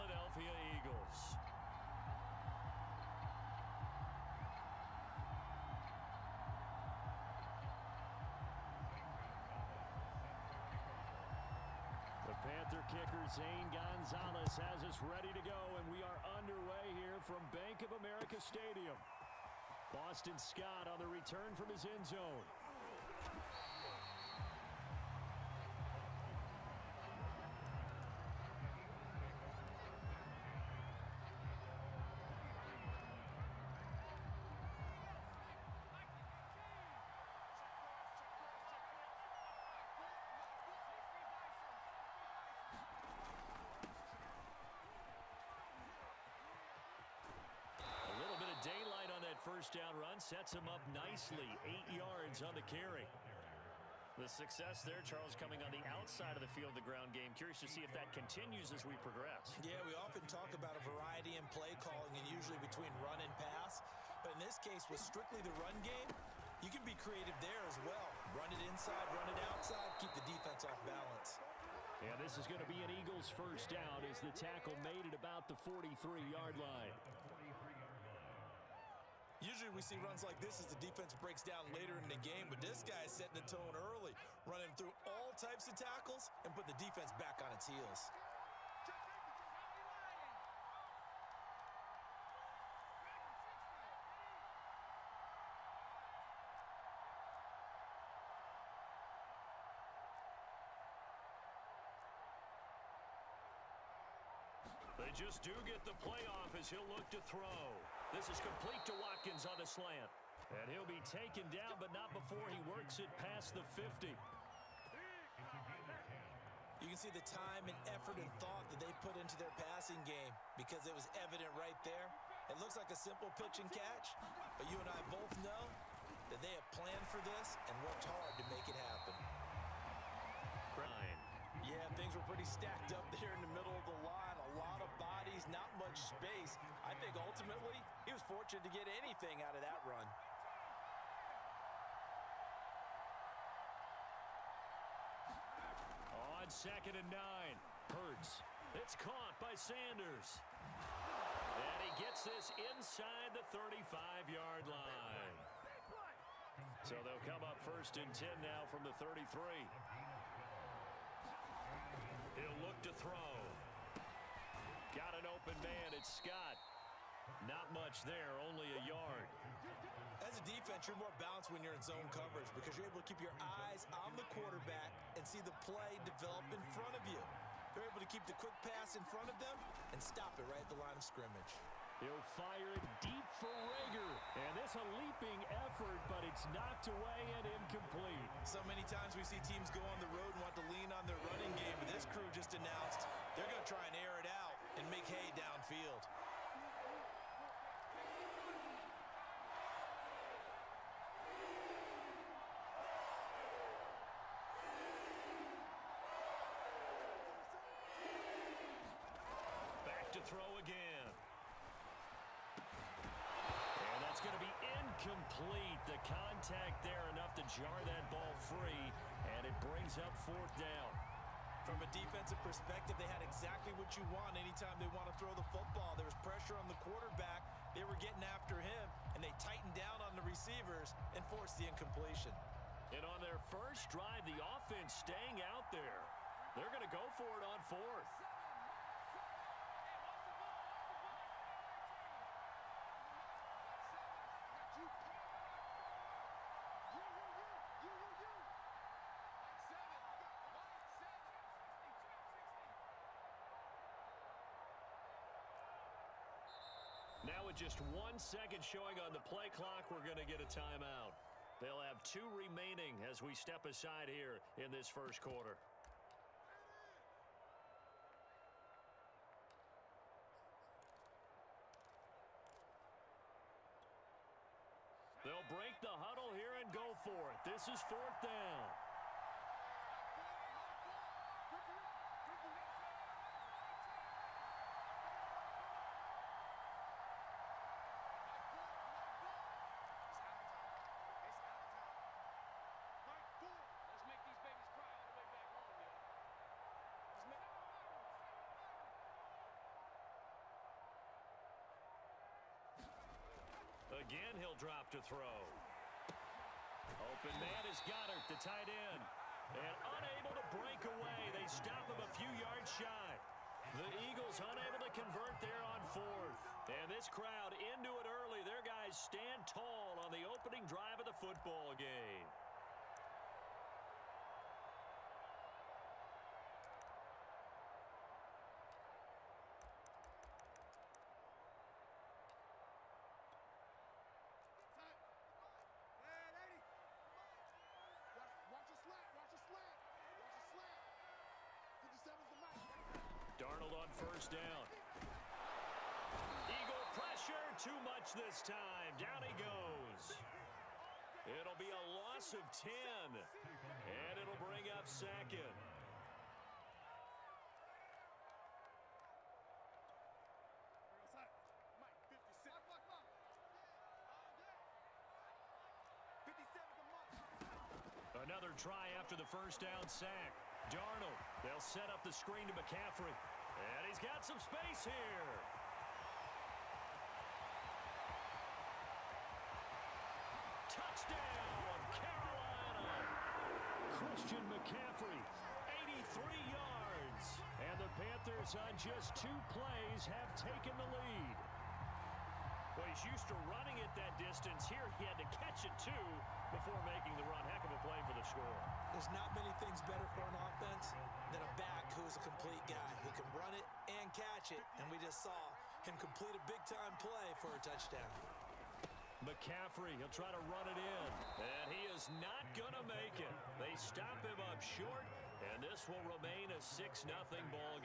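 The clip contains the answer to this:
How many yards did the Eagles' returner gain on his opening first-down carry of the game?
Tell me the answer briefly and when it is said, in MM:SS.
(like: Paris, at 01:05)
8, at 00:51.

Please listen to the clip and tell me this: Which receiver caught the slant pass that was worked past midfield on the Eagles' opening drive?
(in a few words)
Watkins.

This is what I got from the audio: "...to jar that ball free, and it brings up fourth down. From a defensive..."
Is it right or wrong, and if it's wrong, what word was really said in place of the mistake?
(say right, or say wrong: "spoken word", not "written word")
right.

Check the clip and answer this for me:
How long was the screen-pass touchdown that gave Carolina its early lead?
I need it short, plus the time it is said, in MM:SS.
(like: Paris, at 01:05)
83 yards, at 06:25.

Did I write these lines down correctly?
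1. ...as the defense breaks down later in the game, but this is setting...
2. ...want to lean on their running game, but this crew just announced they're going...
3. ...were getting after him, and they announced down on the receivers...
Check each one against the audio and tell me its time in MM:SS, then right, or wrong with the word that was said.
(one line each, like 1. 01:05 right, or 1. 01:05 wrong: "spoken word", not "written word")
1. 01:20 right
2. 03:10 right
3. 03:47 wrong: "tightened", not "announced".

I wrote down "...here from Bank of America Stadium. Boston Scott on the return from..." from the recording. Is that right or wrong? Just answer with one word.
right.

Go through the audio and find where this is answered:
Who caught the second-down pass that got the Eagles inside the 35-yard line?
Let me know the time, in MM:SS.
02:29.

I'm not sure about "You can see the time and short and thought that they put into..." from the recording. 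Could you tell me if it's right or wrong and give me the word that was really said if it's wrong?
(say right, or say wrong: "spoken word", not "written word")
wrong: "effort", not "short".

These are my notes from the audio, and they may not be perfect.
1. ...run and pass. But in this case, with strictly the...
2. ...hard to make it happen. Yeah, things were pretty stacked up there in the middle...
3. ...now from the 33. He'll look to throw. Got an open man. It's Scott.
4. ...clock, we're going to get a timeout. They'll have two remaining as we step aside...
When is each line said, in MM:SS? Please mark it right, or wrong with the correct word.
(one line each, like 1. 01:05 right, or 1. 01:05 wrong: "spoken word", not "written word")
1. 01:02 right
2. 02:08 right
3. 02:38 right
4. 04:19 right.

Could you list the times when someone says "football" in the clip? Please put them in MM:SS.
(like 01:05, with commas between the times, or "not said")
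03:45, 05:21.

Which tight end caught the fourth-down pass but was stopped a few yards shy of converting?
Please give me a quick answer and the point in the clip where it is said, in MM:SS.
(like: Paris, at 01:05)
Goedert, at 05:07.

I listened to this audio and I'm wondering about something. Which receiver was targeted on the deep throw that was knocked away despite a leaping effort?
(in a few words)
Reagor.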